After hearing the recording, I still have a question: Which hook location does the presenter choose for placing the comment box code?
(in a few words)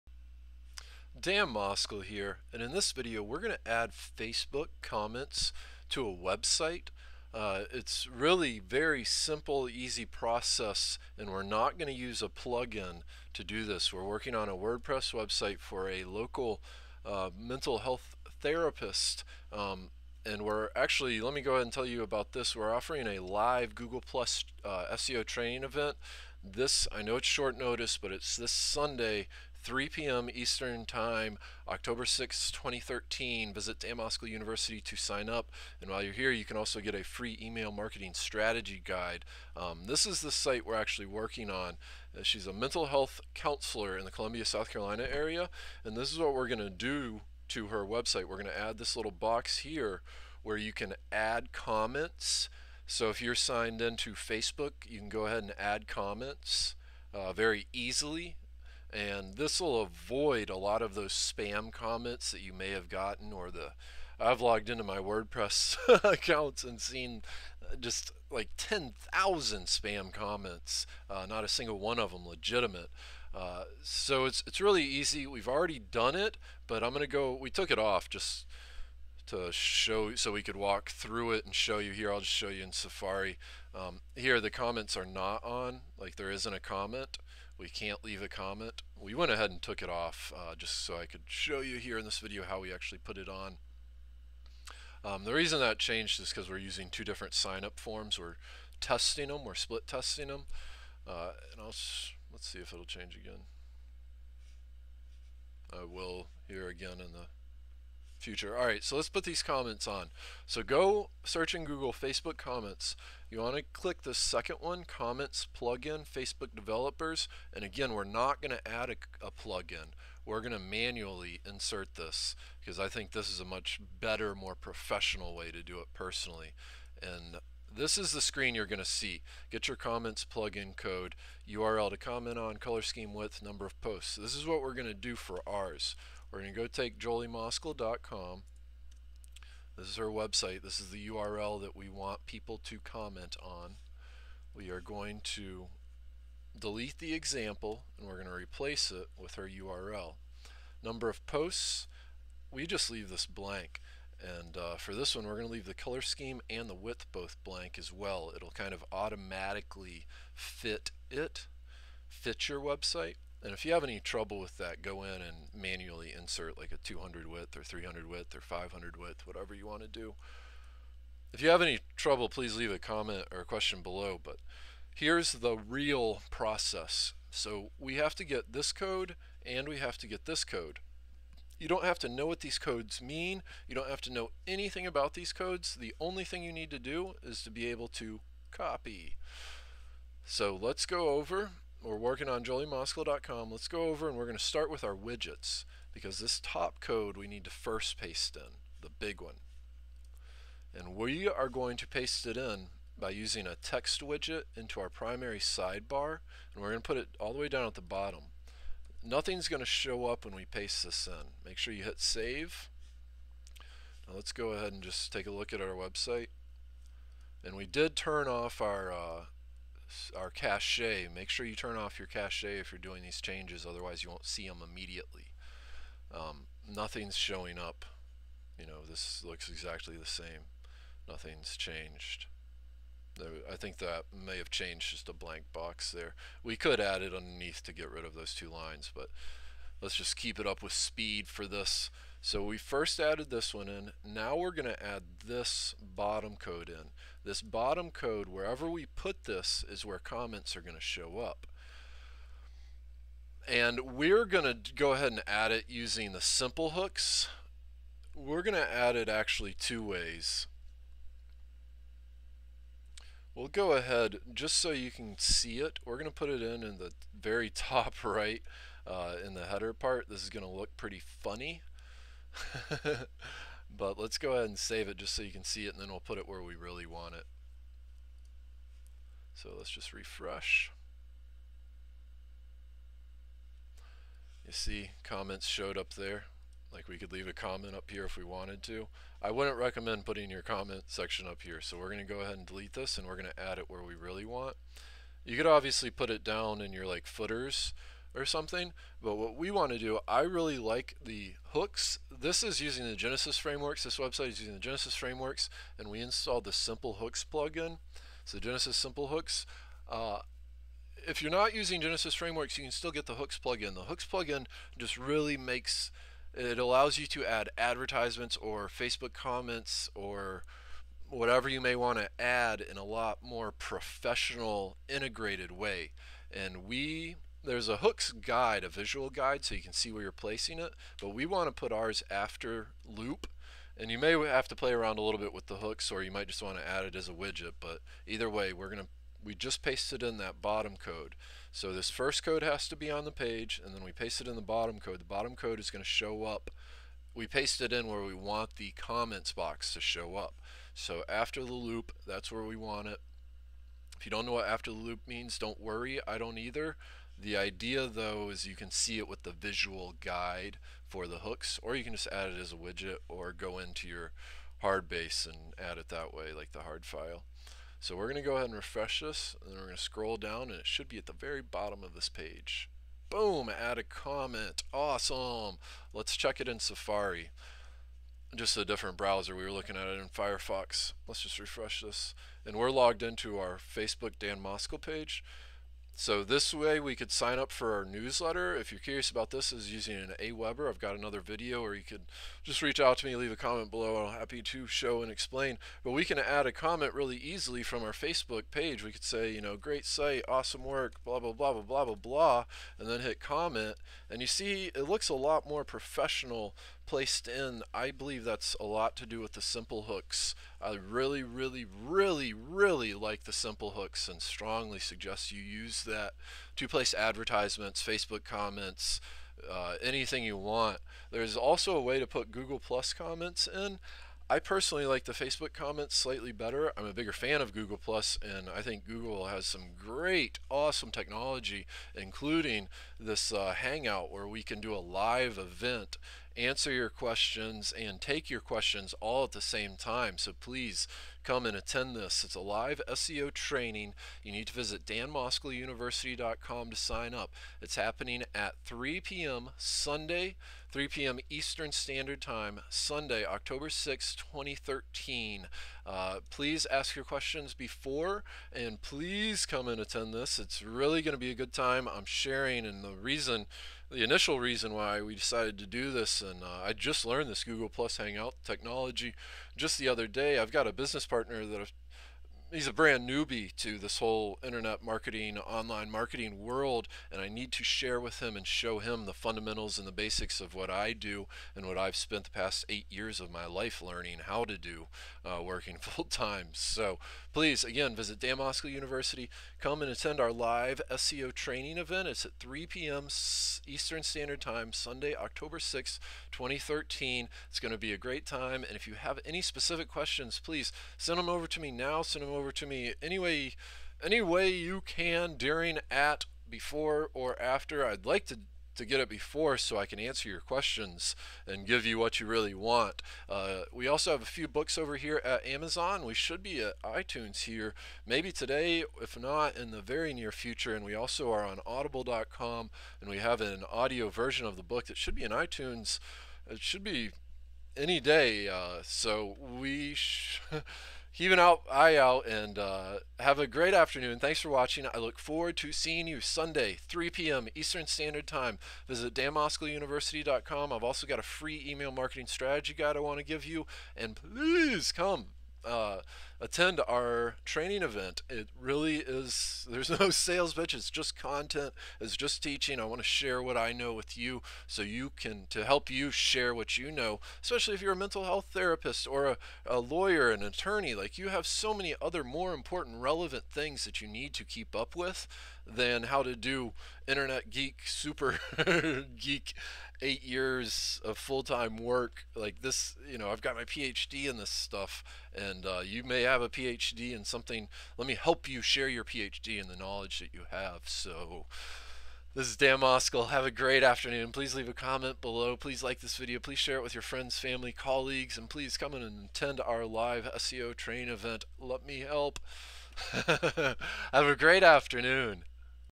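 after loop.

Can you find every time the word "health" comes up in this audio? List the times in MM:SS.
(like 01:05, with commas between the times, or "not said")
00:17, 00:42, 09:18.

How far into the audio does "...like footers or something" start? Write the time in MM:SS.
04:56.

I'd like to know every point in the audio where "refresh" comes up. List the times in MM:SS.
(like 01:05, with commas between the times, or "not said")
04:39, 06:08, 06:21.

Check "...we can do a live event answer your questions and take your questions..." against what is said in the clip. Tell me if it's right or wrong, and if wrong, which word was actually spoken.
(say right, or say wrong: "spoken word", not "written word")
right.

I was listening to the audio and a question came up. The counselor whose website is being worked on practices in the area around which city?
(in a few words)
Columbia, South Carolina.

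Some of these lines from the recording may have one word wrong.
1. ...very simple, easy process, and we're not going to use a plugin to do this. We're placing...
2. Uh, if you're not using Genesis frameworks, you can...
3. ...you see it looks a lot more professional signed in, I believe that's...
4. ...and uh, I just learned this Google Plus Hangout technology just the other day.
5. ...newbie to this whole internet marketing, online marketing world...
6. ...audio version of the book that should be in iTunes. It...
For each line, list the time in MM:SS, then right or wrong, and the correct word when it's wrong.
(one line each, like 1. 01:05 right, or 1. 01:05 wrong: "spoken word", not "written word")
1. 00:08 wrong: "working", not "placing"
2. 05:09 right
3. 06:44 wrong: "placed", not "signed"
4. 07:46 right
5. 07:53 right
6. 08:43 right.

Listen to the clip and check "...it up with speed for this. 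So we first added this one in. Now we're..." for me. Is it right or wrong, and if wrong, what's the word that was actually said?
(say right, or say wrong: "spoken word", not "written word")
right.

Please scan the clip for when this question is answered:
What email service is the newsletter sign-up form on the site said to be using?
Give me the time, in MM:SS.
06:30.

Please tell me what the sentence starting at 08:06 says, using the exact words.
So please, again, visit Dan Moskel University.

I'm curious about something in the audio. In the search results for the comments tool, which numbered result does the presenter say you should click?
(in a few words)
the second one.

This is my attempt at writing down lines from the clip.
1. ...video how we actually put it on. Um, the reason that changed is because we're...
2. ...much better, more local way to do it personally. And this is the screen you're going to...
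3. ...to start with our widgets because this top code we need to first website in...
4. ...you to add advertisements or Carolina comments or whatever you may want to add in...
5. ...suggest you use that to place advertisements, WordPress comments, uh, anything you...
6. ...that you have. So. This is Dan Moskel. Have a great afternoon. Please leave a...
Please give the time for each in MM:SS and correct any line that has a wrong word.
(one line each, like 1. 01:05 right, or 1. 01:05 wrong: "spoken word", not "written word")
1. 01:32 right
2. 02:03 wrong: "professional", not "local"
3. 03:14 wrong: "paste", not "website"
4. 05:16 wrong: "Facebook", not "Carolina"
5. 06:54 wrong: "Facebook", not "WordPress"
6. 09:40 right.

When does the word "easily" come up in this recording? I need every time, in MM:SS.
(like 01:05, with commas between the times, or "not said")
00:57, 06:37.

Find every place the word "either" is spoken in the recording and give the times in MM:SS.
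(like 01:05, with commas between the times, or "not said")
05:38, 05:56.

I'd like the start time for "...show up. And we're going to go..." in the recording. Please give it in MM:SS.
04:10.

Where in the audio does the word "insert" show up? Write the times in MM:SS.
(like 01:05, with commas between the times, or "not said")
02:01, 02:46.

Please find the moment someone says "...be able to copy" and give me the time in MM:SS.
03:07.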